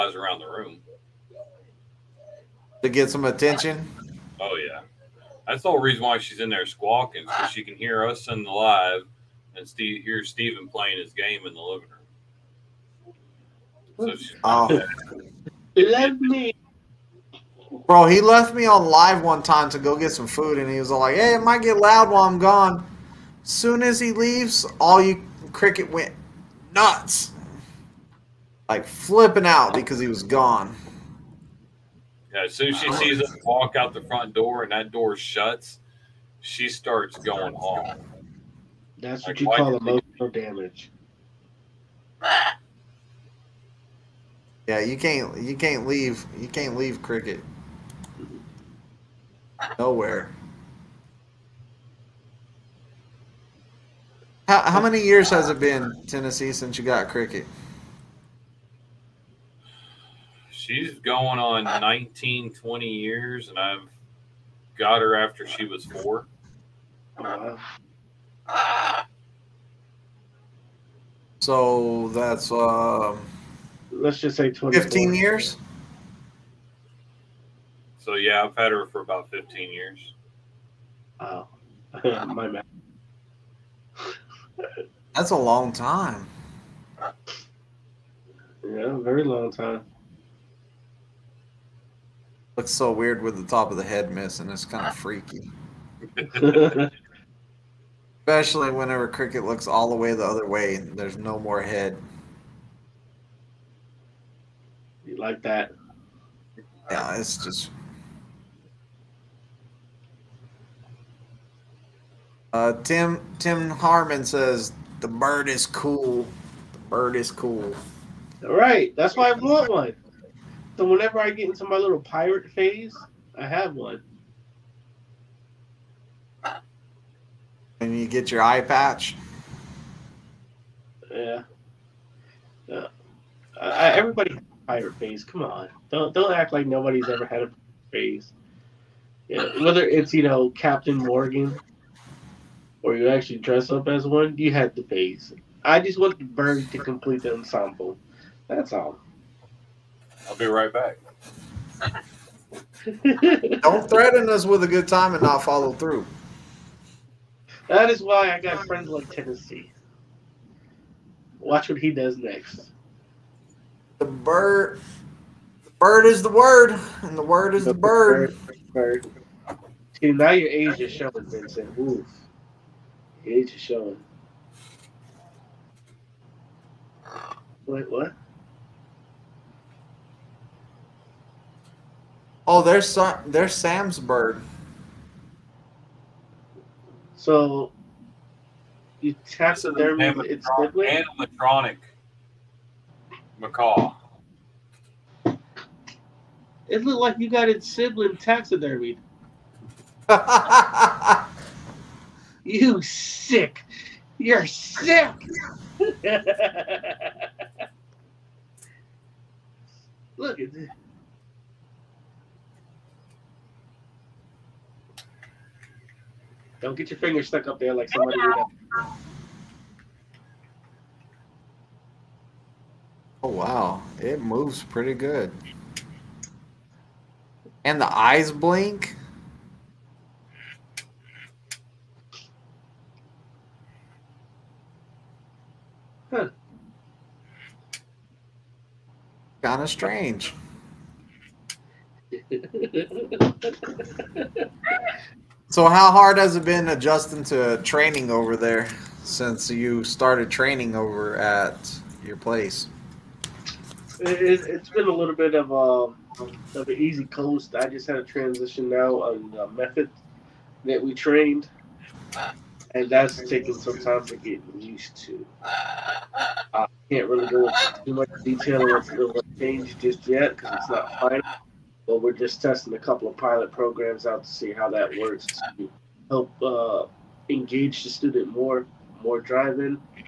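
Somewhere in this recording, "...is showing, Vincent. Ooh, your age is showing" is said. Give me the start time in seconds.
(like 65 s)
170 s.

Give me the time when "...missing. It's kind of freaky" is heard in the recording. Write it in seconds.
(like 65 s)
94 s.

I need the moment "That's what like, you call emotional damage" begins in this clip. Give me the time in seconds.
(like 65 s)
38 s.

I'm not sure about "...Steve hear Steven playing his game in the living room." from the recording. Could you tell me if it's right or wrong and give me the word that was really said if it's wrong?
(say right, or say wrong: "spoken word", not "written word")
right.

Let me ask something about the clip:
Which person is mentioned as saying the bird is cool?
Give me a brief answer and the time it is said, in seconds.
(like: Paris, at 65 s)
Tim Harmon, at 112 s.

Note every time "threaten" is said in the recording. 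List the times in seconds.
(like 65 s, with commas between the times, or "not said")
153 s.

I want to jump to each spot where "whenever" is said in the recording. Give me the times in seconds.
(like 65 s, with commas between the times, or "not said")
98 s, 120 s.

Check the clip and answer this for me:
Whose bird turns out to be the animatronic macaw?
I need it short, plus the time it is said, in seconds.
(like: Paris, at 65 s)
Sam's, at 183 s.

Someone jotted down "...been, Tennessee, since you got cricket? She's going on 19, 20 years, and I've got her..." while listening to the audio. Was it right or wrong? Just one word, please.
right.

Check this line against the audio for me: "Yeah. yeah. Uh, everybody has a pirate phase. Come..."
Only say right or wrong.
right.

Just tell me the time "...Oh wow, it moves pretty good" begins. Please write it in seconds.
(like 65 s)
223 s.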